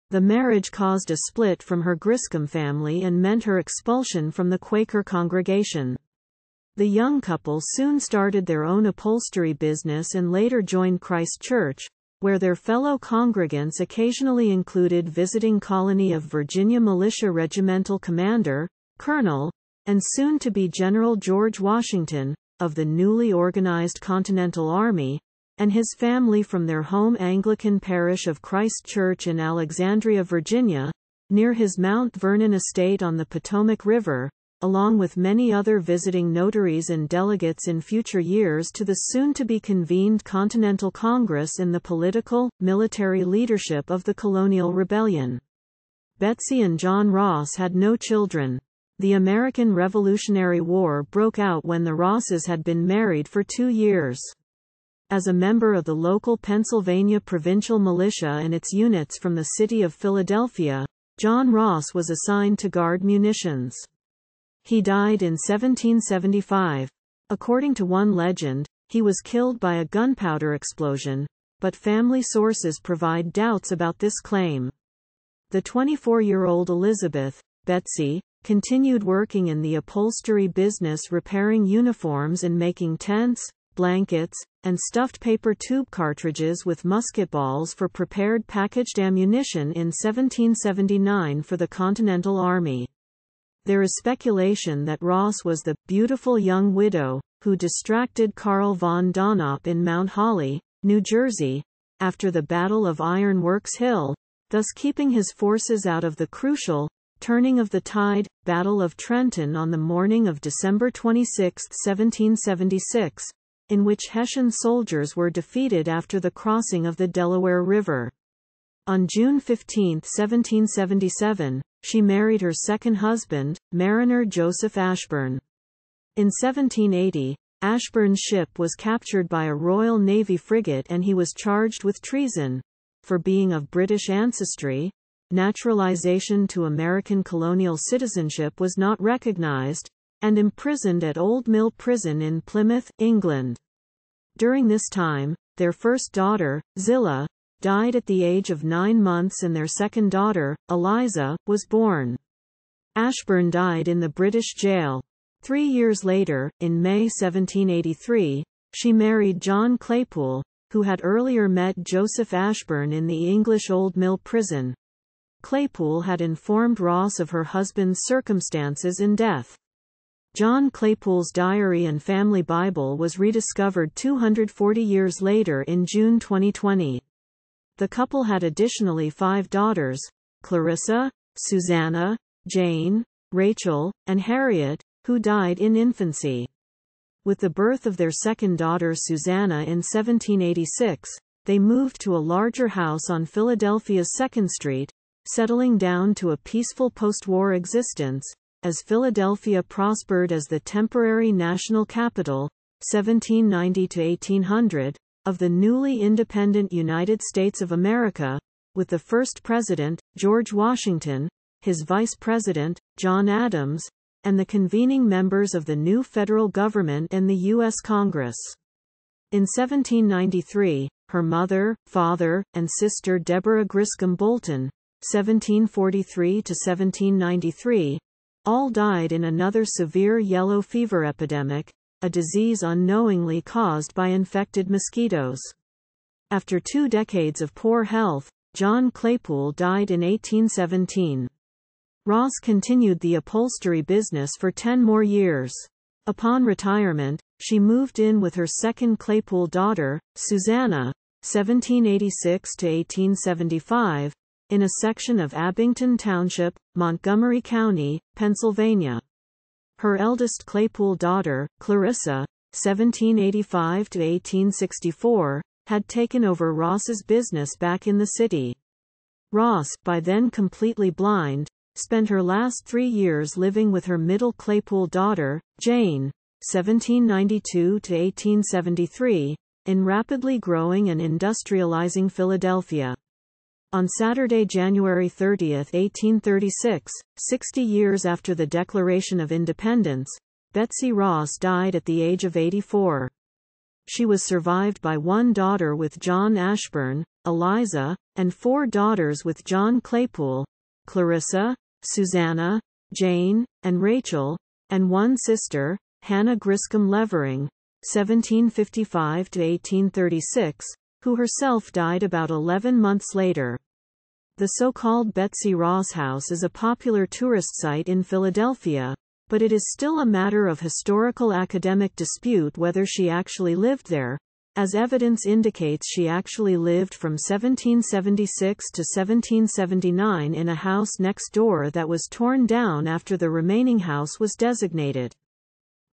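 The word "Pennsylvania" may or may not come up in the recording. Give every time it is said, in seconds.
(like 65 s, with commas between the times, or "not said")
56 s, 258 s.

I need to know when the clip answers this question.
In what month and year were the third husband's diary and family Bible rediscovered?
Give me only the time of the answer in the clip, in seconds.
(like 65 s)
175 s.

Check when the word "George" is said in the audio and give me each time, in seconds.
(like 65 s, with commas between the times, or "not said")
21 s, 210 s.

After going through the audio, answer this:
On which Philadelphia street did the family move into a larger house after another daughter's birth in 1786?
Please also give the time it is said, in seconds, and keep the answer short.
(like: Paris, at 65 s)
2nd Street, at 194 s.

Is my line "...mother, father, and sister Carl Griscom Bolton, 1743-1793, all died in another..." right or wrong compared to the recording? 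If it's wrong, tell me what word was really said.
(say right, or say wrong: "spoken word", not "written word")
wrong: "Deborah", not "Carl".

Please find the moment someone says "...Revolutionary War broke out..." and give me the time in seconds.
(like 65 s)
49 s.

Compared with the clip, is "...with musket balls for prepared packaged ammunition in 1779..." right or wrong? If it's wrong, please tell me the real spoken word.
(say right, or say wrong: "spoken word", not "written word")
right.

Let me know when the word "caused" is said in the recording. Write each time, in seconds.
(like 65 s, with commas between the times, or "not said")
0 s, 233 s.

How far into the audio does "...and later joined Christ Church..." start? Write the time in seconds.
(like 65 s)
10 s.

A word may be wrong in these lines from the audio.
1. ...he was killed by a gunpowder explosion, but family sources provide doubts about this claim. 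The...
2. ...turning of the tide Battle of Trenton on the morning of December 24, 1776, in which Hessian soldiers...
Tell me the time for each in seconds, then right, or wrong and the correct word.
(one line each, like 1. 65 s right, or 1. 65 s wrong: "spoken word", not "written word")
1. 68 s right
2. 107 s wrong: "26", not "24".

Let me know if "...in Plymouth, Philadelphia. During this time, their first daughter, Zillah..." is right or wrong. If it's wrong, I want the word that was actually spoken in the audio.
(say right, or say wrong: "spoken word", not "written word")
wrong: "England", not "Philadelphia".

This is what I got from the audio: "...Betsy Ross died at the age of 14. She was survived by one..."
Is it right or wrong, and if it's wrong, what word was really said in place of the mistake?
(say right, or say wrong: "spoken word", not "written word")
wrong: "84", not "14".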